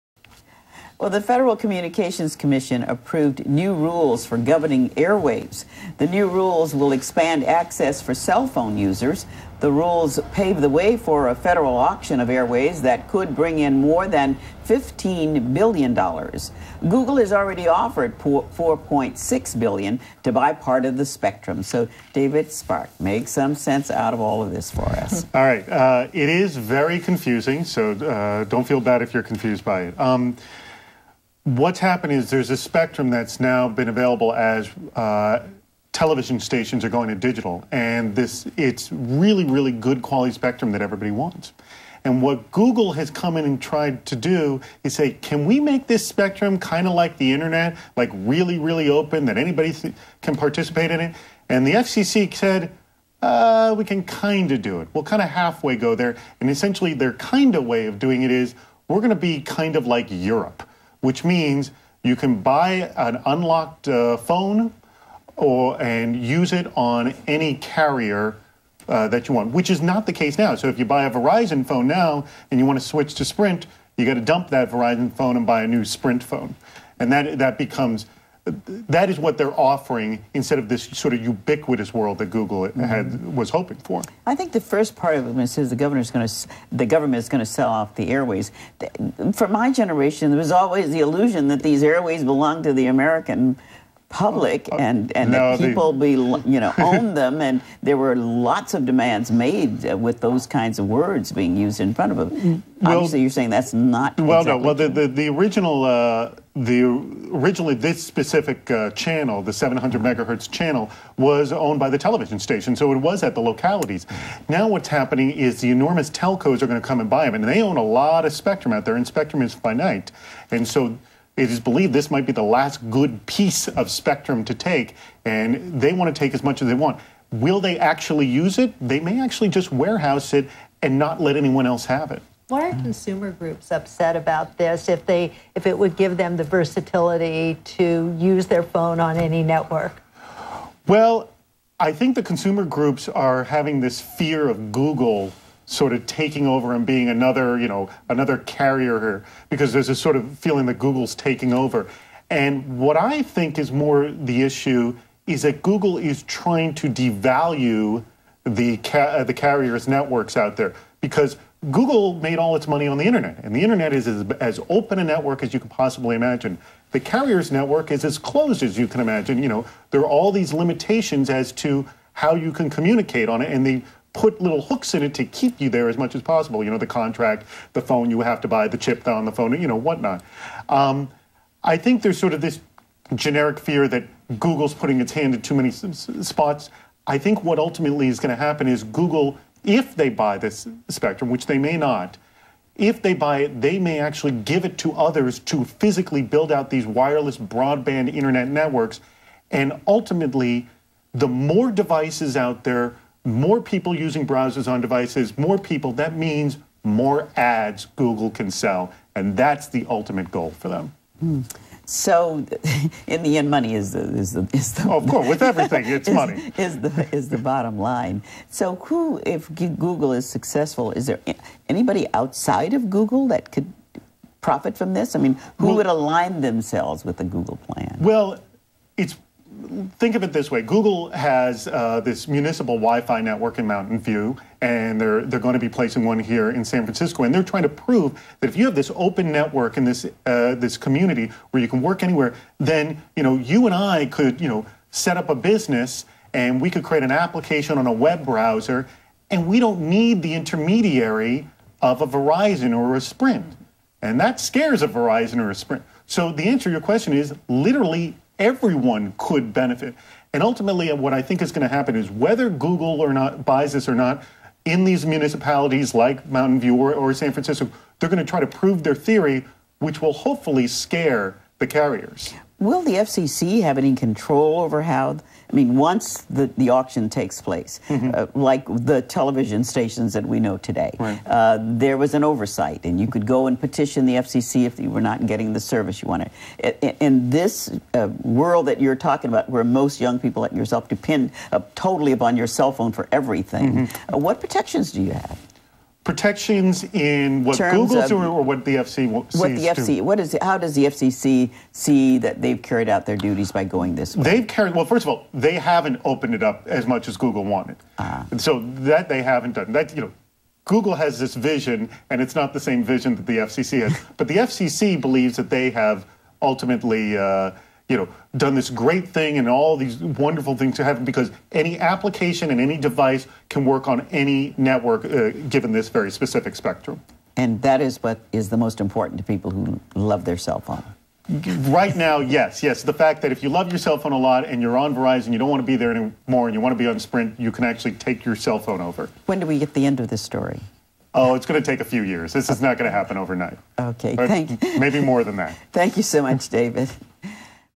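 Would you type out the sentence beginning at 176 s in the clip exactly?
You know, the contract, the phone you have to buy, the chip on the phone, you know, whatnot.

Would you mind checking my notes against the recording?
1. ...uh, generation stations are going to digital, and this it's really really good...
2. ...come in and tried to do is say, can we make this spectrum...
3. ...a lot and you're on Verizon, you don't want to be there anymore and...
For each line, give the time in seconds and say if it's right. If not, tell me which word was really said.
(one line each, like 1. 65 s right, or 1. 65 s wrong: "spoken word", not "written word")
1. 34 s wrong: "television", not "generation"
2. 43 s right
3. 334 s right.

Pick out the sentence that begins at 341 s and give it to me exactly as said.
Oh, it's going to take a few years.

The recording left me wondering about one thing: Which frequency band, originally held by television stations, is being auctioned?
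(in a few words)
700 megahertz.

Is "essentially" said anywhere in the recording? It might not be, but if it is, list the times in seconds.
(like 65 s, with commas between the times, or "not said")
56 s.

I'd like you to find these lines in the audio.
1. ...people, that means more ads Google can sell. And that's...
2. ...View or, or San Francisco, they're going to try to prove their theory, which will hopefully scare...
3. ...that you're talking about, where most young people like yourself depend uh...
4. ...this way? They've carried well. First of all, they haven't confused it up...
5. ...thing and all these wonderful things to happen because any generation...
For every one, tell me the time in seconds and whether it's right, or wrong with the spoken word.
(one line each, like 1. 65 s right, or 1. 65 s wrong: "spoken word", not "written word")
1. 205 s right
2. 266 s right
3. 288 s right
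4. 303 s wrong: "opened", not "confused"
5. 319 s wrong: "application", not "generation".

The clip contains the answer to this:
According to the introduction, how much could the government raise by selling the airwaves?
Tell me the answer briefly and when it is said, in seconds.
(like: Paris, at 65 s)
more than $15 billion, at 13 s.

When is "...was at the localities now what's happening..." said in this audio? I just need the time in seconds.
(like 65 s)
112 s.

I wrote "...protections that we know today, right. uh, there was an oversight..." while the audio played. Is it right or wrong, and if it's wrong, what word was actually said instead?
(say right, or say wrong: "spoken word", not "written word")
wrong: "stations", not "protections".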